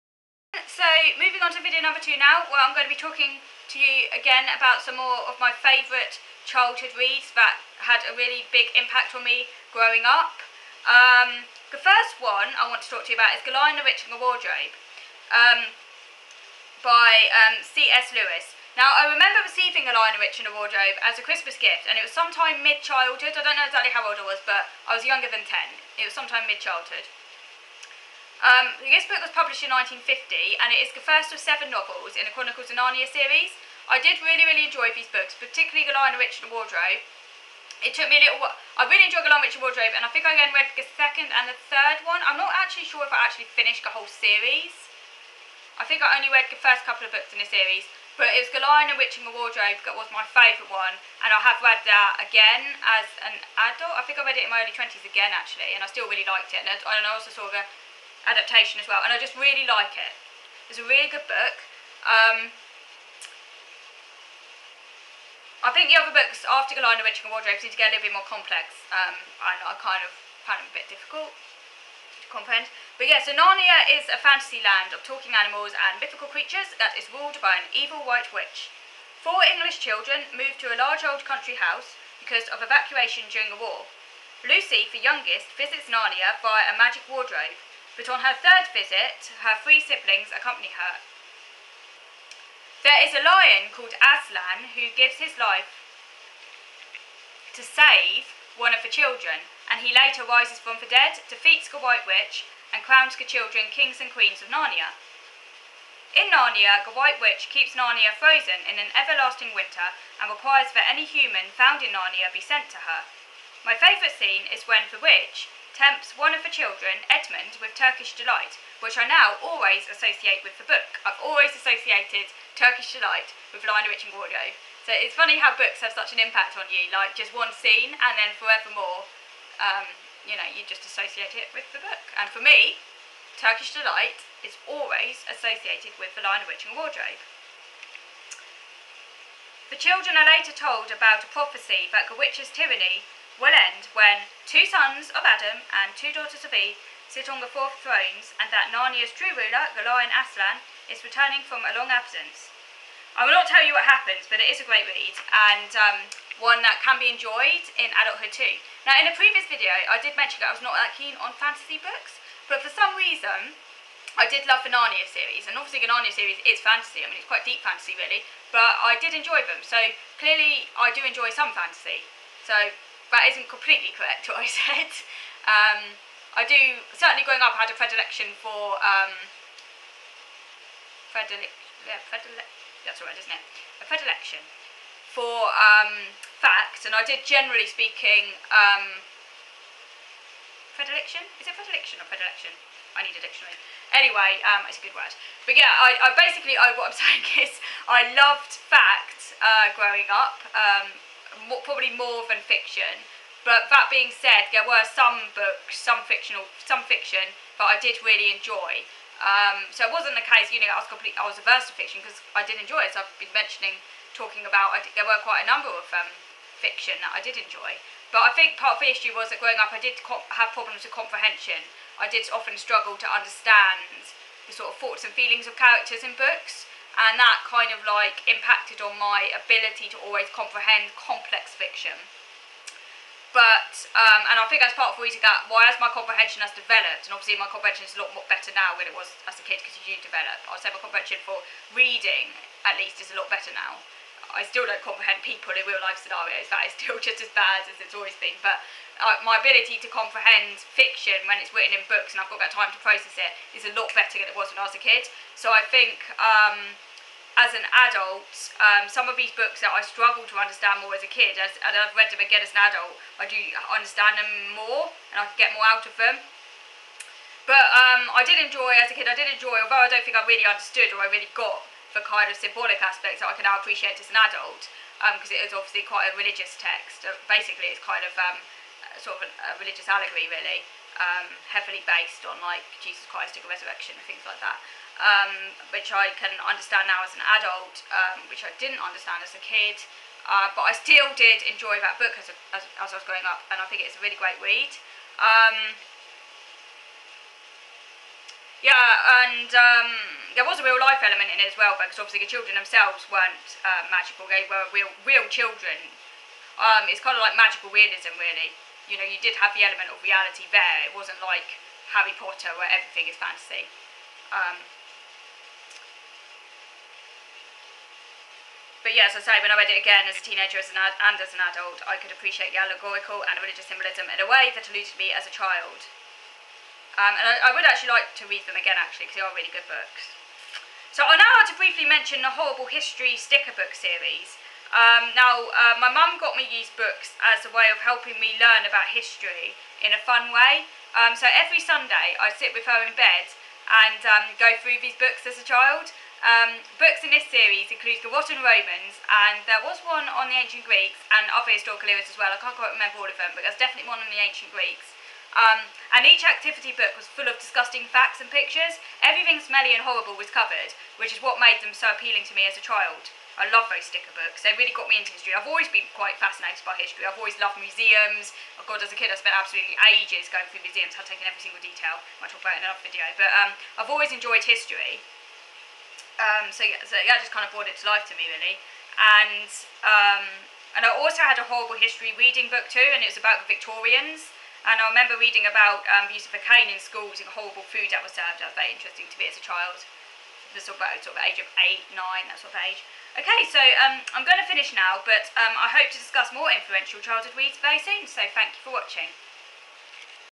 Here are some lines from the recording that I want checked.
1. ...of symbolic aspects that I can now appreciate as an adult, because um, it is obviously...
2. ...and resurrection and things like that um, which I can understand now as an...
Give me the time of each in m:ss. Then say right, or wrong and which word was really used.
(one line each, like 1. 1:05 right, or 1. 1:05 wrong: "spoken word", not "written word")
1. 4:32 right
2. 4:43 right.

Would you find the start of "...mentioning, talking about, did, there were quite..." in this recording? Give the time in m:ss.
3:33.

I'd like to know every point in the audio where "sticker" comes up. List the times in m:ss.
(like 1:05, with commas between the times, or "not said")
5:33, 6:03.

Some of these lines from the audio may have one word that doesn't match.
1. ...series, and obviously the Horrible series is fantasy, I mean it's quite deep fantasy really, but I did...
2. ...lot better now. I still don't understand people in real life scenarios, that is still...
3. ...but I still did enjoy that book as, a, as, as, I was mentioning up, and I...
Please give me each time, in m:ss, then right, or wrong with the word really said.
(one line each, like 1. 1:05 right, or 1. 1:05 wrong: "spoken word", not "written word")
1. 2:45 wrong: "Narnia", not "Horrible"
2. 4:03 wrong: "comprehend", not "understand"
3. 4:50 wrong: "growing", not "mentioning".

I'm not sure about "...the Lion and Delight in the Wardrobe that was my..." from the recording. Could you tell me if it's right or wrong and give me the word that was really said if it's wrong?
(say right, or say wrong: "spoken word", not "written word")
wrong: "Witch", not "Delight".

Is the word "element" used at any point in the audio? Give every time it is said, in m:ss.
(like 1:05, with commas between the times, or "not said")
5:01, 5:09.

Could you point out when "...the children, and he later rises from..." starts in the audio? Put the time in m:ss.
1:38.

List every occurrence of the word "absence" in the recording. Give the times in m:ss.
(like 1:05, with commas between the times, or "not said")
2:31.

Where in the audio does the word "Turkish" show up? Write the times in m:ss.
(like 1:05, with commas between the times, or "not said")
1:57, 2:02, 2:13.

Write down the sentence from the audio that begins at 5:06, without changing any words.
Um, it's kind of like magical realism, really.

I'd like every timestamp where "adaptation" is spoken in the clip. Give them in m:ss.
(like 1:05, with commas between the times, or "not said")
0:58.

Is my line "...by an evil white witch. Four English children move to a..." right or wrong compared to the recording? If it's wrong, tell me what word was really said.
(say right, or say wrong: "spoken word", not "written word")
right.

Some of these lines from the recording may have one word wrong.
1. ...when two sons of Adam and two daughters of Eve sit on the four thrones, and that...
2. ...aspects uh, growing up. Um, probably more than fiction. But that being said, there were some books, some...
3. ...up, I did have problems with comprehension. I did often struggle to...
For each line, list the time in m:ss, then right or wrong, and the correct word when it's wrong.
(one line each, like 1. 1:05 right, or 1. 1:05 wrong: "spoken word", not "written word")
1. 2:23 right
2. 3:18 wrong: "facts", not "aspects"
3. 3:39 right.